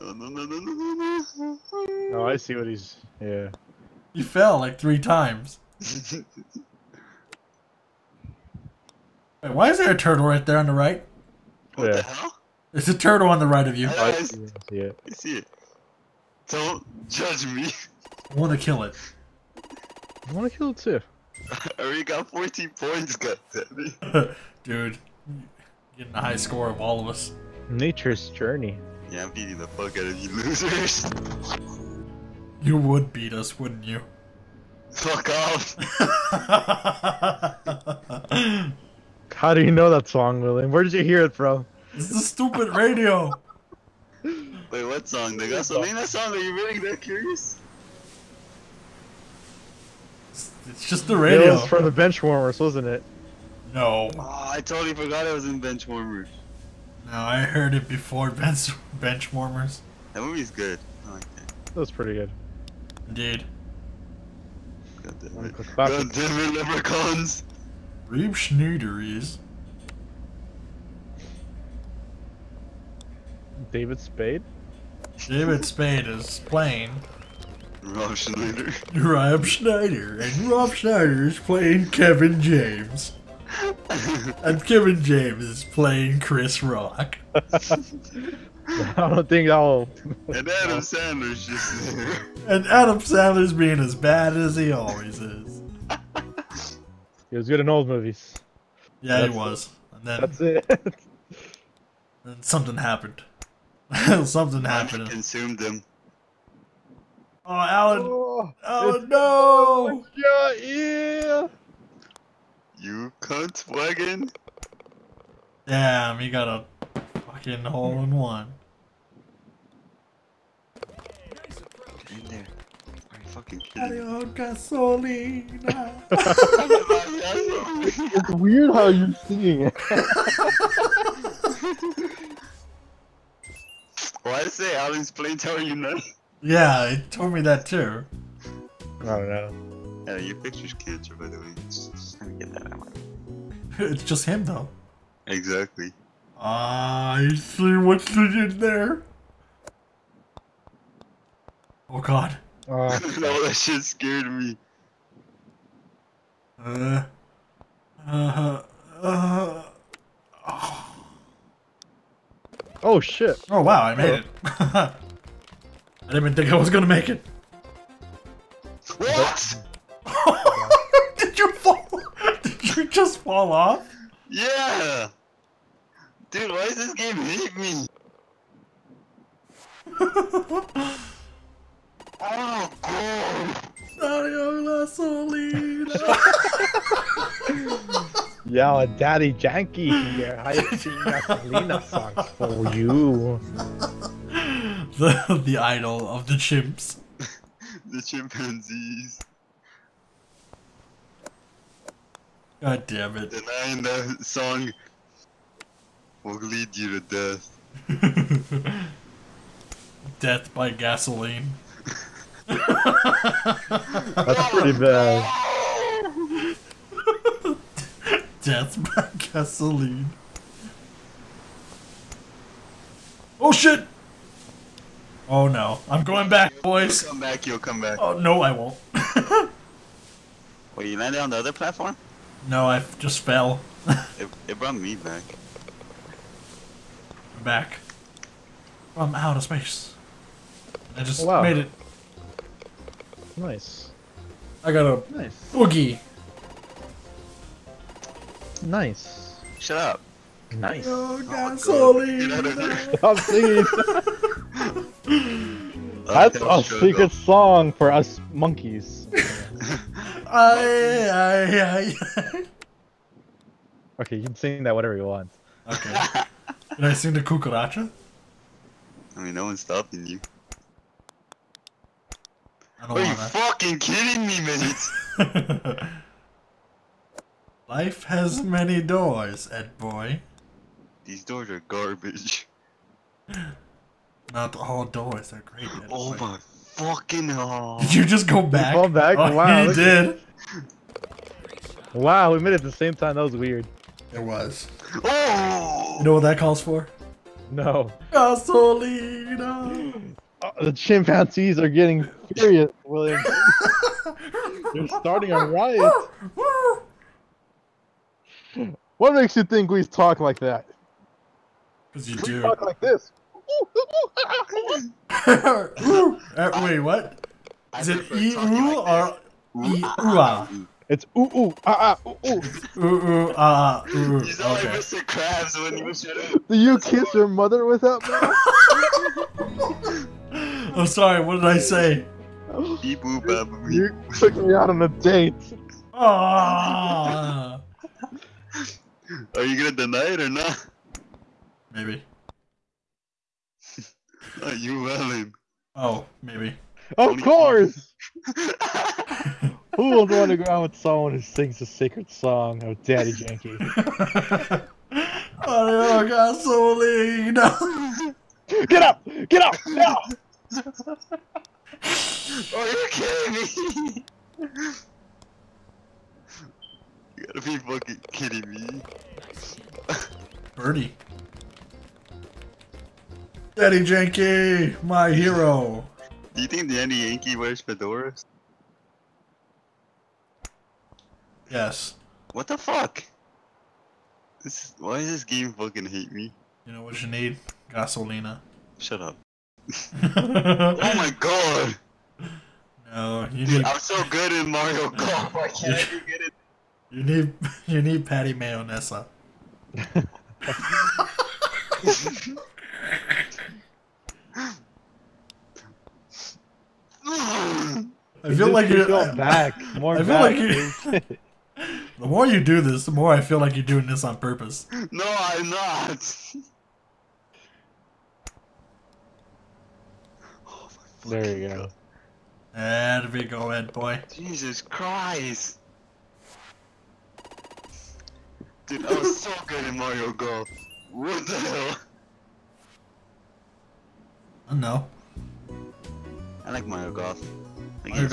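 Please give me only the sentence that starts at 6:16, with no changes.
Do you think the Daddy Yankee wears fedoras?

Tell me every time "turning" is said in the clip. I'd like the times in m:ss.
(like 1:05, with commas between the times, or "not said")
not said.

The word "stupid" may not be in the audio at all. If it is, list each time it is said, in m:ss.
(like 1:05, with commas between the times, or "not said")
0:42.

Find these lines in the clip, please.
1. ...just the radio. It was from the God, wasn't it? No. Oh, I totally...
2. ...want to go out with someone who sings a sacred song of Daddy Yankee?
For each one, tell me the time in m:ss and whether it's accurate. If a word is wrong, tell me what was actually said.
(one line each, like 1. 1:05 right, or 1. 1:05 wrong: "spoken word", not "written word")
1. 0:50 wrong: "Benchwarmers", not "God"
2. 5:50 right.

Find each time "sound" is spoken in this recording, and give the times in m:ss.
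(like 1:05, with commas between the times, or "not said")
5:24.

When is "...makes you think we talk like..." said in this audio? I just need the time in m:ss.
5:09.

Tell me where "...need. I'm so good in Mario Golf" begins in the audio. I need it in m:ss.
6:33.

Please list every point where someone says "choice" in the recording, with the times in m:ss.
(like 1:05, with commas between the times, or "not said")
not said.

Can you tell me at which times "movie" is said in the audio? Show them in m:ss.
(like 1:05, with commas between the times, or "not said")
1:00, 1:37.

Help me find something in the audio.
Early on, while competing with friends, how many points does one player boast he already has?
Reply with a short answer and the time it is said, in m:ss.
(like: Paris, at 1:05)
14, at 0:22.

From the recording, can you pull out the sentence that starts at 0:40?
Where did you hear it from?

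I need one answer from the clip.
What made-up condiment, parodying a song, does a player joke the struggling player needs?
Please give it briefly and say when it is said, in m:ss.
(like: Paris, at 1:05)
Patty Mayonesa, at 6:38.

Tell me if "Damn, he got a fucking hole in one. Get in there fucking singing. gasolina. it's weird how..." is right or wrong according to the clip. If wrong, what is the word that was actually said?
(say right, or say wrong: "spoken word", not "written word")
wrong: "kidding", not "singing".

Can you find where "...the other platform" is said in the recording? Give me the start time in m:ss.
3:51.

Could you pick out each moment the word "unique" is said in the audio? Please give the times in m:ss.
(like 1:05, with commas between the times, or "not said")
not said.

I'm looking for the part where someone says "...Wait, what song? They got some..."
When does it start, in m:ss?
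0:44.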